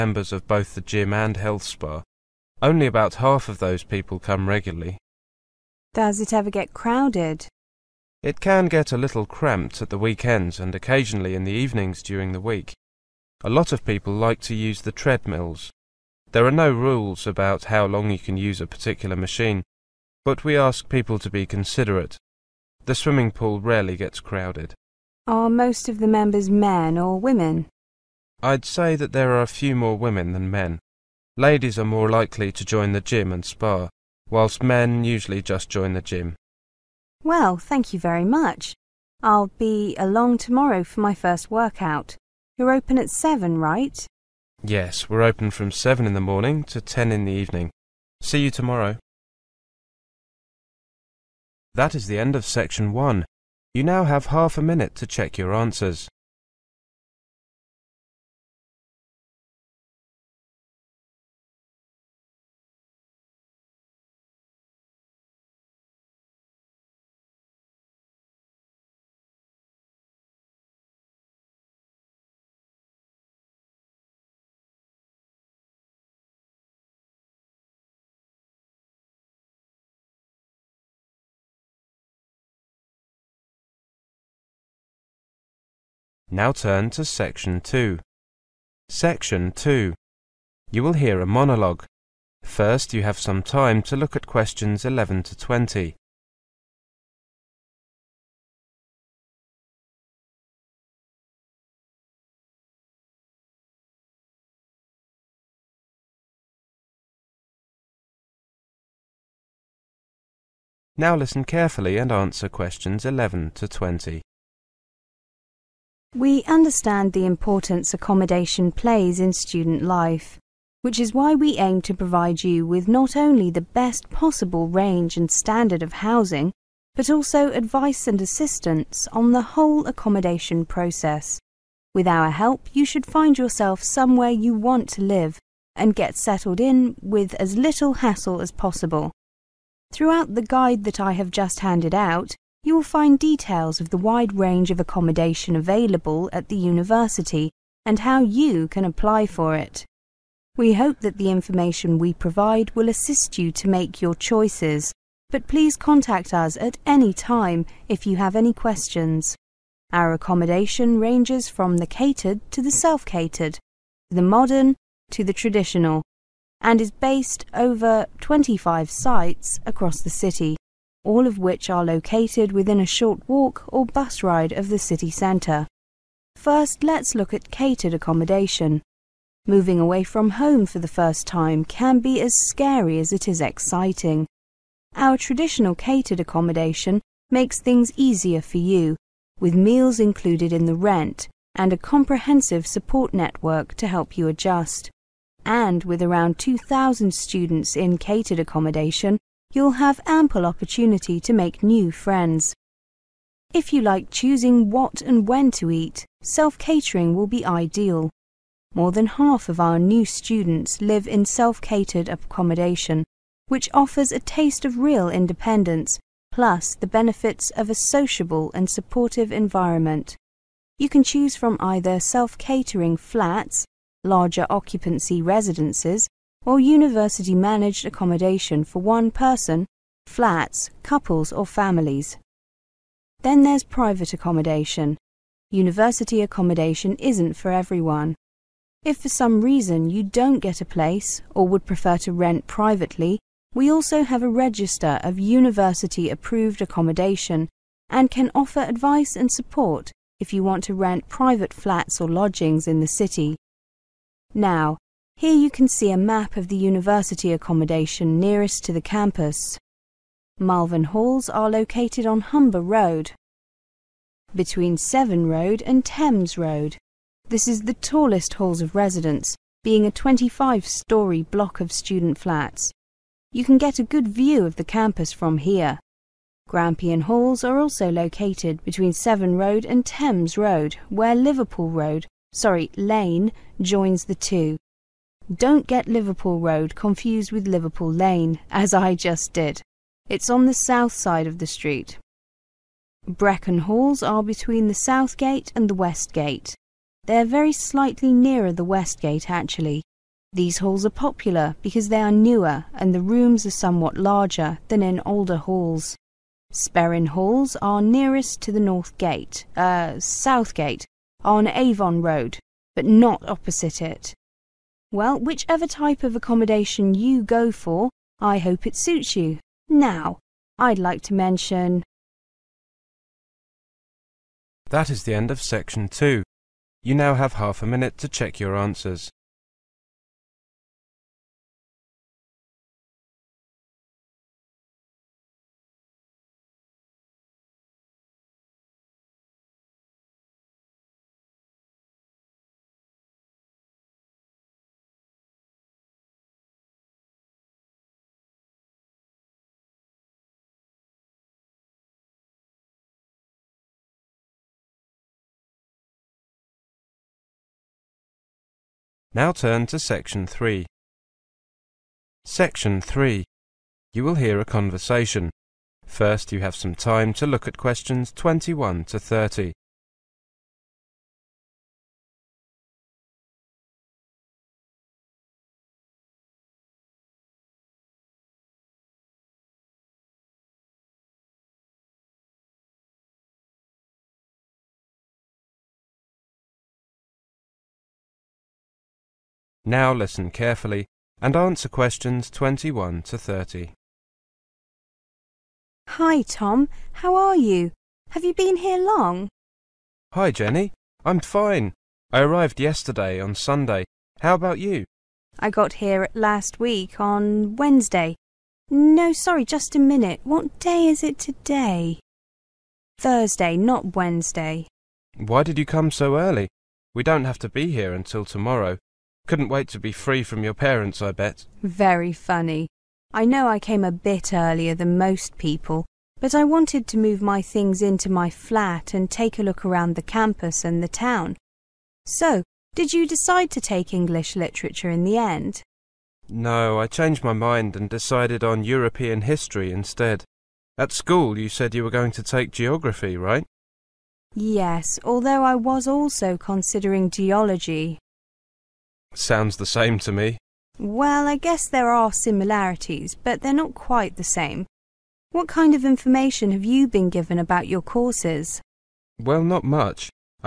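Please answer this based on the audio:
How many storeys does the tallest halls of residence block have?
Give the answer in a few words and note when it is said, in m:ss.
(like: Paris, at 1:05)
25, at 4:29.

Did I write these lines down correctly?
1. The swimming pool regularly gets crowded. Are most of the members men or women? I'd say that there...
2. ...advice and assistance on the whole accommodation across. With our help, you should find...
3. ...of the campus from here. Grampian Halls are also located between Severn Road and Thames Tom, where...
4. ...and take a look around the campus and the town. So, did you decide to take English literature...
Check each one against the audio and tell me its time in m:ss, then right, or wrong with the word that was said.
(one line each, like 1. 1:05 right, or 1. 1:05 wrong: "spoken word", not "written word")
1. 0:22 wrong: "rarely", not "regularly"
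2. 2:07 wrong: "process", not "across"
3. 4:34 wrong: "Road", not "Tom"
4. 7:08 right.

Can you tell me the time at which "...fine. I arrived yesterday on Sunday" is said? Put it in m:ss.
6:41.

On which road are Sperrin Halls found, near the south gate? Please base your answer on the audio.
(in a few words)
Avon Road.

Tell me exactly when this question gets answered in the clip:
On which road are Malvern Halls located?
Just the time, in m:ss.
4:22.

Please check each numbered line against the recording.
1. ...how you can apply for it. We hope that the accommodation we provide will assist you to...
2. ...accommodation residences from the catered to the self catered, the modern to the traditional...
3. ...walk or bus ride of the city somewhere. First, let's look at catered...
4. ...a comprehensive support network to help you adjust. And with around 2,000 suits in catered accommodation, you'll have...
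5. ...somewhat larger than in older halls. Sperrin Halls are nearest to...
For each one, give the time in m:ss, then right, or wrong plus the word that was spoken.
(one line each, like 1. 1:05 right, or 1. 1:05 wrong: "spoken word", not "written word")
1. 2:28 wrong: "information", not "accommodation"
2. 2:40 wrong: "ranges", not "residences"
3. 2:53 wrong: "centre", not "somewhere"
4. 3:11 wrong: "students", not "suits"
5. 5:03 right.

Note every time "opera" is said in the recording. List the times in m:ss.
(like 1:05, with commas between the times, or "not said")
not said.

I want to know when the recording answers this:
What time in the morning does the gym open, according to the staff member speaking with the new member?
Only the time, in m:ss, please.
0:45.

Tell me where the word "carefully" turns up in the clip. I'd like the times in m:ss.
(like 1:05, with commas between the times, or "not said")
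1:51, 6:30.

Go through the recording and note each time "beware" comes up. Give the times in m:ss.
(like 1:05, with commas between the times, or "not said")
not said.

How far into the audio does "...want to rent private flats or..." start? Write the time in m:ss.
4:10.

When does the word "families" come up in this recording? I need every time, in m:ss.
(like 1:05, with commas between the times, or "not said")
3:51.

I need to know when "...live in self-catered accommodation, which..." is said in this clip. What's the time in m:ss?
3:30.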